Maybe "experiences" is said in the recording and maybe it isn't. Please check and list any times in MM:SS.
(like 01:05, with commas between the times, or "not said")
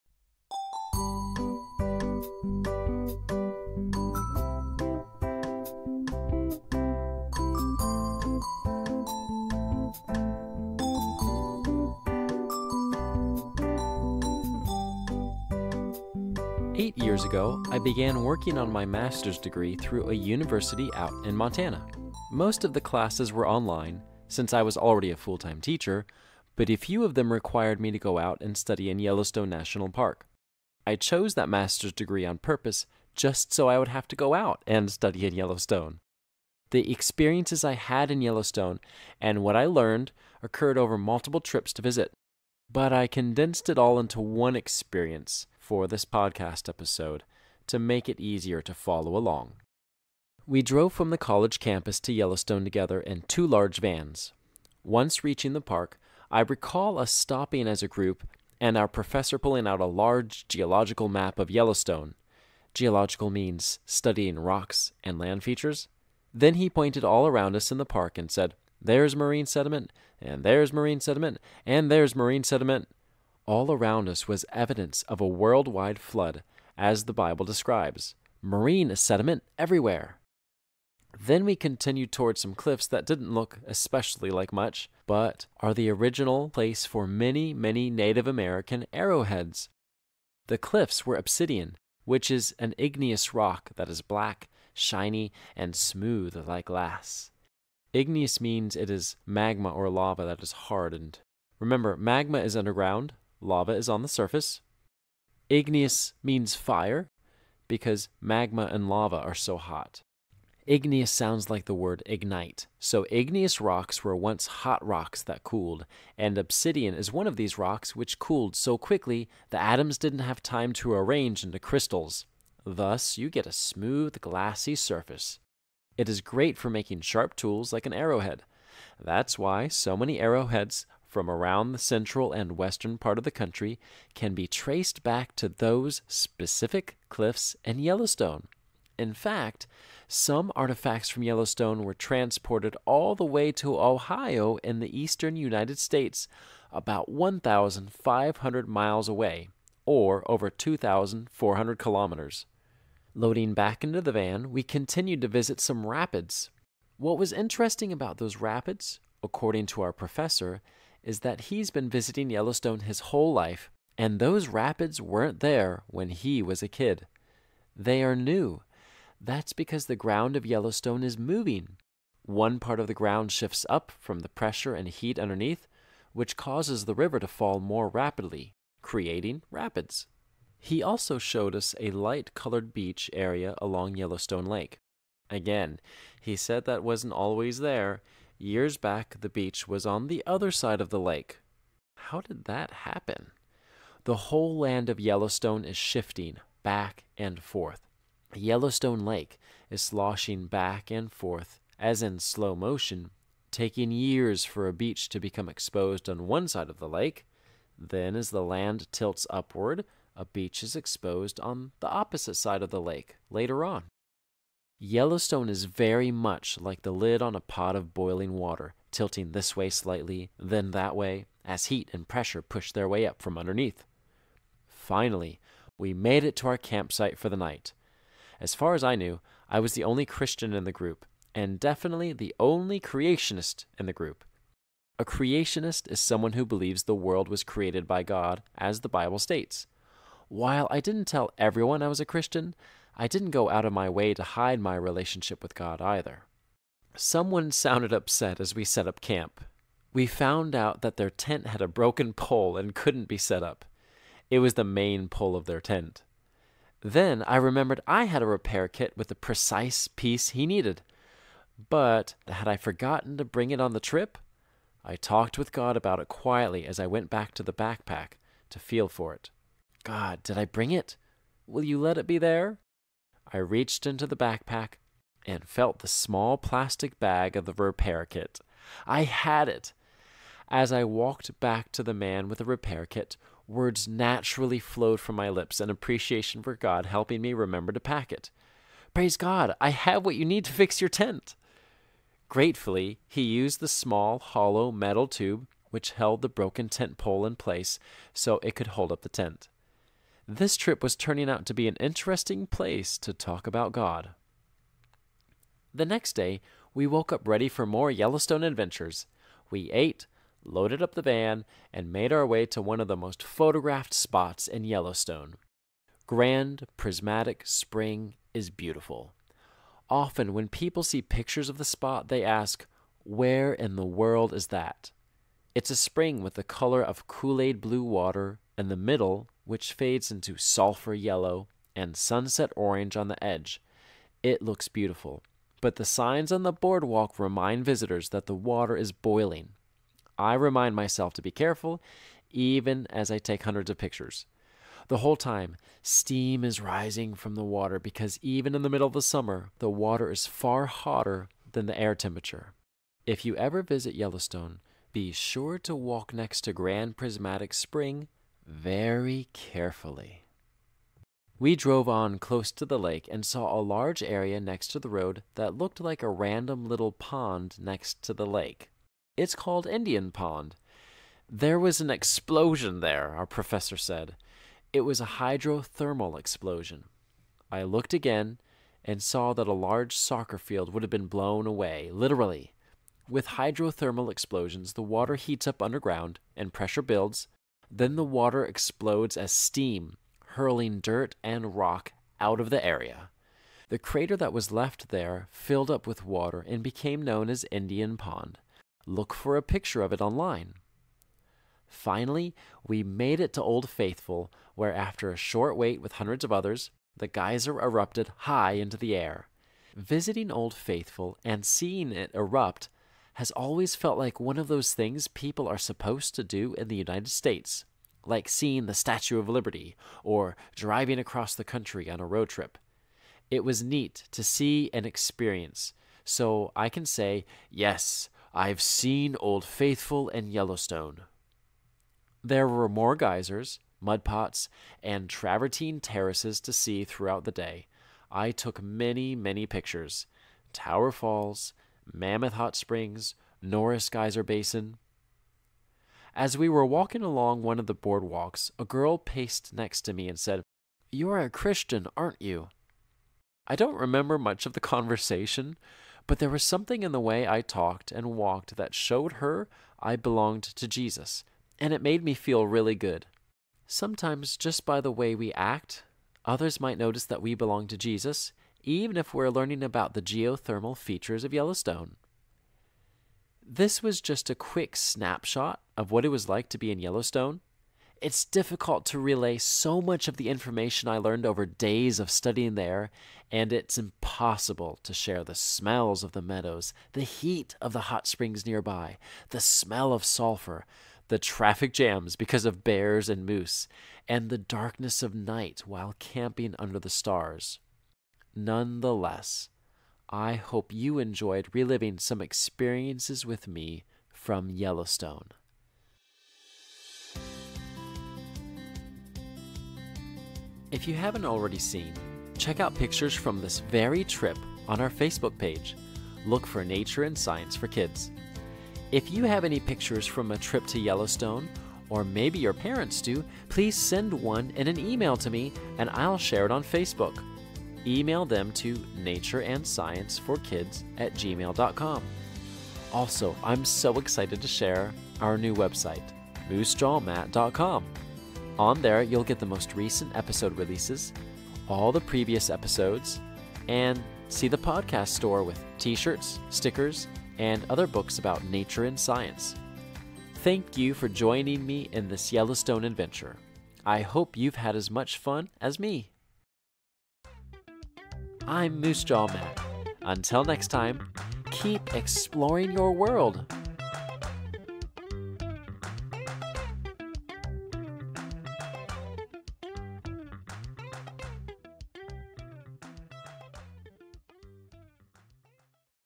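00:36, 00:44, 07:04, 08:22.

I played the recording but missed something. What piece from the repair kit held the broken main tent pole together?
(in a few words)
small hollow metal tube.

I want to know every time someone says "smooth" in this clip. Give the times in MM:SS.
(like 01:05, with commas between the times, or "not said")
01:35, 02:03.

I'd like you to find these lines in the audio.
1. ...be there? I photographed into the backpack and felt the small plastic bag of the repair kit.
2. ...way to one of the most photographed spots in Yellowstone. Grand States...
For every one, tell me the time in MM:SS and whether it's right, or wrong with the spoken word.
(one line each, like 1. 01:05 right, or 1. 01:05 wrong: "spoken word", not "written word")
1. 04:32 wrong: "reached", not "photographed"
2. 05:12 wrong: "Prismatic", not "States".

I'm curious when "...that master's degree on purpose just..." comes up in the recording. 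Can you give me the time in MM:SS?
00:31.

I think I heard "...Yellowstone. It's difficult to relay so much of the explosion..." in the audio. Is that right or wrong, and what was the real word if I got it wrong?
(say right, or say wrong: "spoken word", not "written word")
wrong: "information", not "explosion".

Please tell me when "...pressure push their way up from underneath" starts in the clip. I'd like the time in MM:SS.
03:42.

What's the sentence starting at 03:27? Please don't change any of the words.
Then, as the land tilts upward, a beach is exposed on the opposite side of the lake later on.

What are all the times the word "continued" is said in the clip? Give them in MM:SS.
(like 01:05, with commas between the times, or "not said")
01:21, 02:34.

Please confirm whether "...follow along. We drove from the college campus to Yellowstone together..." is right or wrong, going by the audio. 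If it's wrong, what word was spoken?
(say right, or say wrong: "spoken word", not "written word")
right.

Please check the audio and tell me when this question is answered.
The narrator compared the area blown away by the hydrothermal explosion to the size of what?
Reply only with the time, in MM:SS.
06:19.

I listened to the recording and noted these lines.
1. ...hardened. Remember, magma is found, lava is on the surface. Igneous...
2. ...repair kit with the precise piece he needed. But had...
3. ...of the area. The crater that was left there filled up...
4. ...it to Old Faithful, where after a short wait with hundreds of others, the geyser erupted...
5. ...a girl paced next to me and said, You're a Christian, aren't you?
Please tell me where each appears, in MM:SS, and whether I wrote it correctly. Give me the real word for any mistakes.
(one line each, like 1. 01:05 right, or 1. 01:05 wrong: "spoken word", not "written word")
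1. 01:40 wrong: "underground", not "found"
2. 04:18 right
3. 06:32 right
4. 06:43 right
5. 07:28 right.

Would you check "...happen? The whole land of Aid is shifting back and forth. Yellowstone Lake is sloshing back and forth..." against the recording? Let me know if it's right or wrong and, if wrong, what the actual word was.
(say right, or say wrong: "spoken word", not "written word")
wrong: "Yellowstone", not "Aid".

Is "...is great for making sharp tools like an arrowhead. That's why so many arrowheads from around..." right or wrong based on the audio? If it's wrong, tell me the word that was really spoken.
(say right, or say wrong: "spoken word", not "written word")
right.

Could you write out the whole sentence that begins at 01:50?
Igneous sounds like the word ignite.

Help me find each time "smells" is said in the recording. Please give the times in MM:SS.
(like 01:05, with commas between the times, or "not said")
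08:05, 08:09.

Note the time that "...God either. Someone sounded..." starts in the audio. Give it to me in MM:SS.
04:05.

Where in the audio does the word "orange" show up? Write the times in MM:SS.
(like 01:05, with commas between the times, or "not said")
05:32.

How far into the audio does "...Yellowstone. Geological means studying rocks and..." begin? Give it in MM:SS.
01:01.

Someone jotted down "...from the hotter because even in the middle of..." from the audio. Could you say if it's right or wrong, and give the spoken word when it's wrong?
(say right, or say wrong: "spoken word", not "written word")
wrong: "water", not "hotter".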